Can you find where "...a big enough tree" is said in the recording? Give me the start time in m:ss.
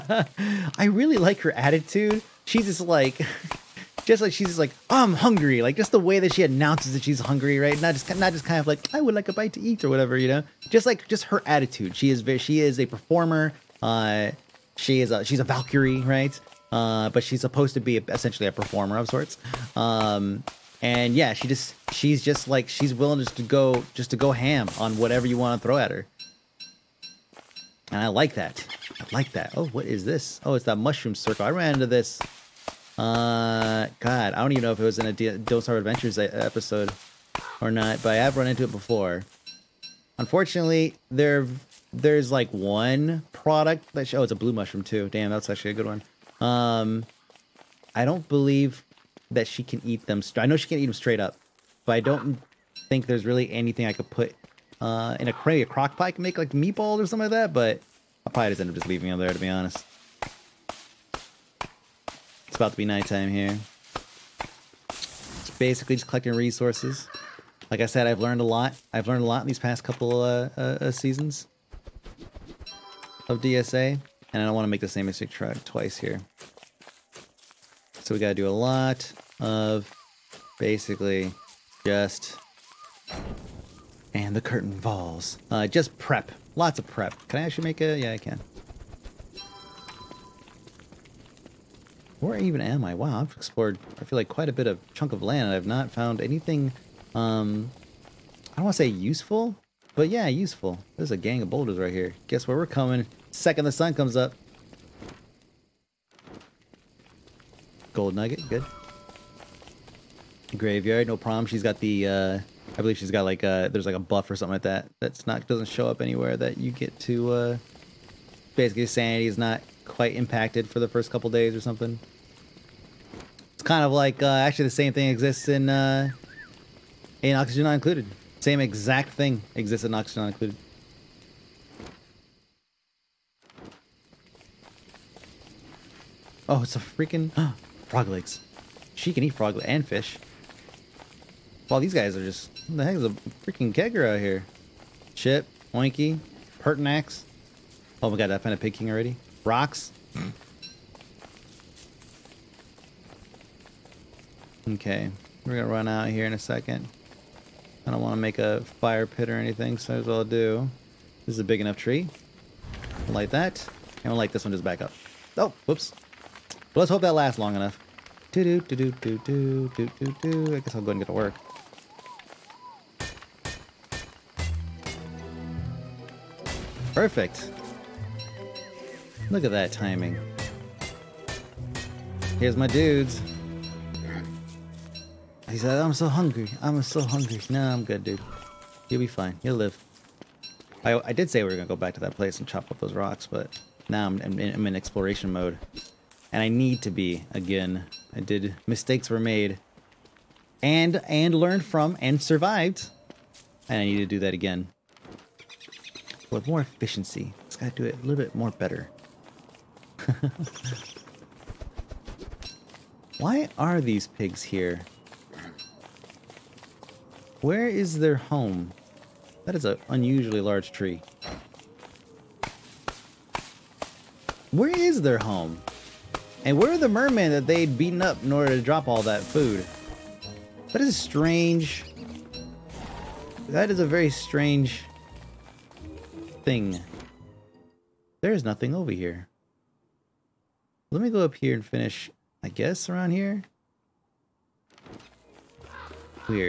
2:41.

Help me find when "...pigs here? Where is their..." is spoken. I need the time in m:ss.
3:34.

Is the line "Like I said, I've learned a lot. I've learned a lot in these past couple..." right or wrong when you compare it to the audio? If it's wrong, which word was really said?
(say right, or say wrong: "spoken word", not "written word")
right.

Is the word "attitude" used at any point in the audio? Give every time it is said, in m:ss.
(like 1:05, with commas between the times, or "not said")
0:01, 0:11.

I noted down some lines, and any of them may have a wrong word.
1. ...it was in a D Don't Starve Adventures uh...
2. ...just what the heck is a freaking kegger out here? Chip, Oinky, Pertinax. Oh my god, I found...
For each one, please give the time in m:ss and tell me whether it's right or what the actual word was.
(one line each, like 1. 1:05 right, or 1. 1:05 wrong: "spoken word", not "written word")
1. 0:34 right
2. 2:22 right.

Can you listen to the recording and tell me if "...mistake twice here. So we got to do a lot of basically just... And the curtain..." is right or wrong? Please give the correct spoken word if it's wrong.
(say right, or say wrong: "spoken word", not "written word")
right.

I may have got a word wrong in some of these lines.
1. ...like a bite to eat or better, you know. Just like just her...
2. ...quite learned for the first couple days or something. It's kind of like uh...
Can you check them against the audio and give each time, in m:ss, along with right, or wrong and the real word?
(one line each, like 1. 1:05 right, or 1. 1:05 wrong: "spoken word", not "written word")
1. 0:09 wrong: "whatever", not "better"
2. 1:59 wrong: "impacted", not "learned".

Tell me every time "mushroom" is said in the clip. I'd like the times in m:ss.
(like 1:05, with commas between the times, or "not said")
0:30, 0:44.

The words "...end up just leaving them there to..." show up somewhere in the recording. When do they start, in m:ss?
0:58.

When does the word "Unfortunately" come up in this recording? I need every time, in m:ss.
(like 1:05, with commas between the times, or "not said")
0:40.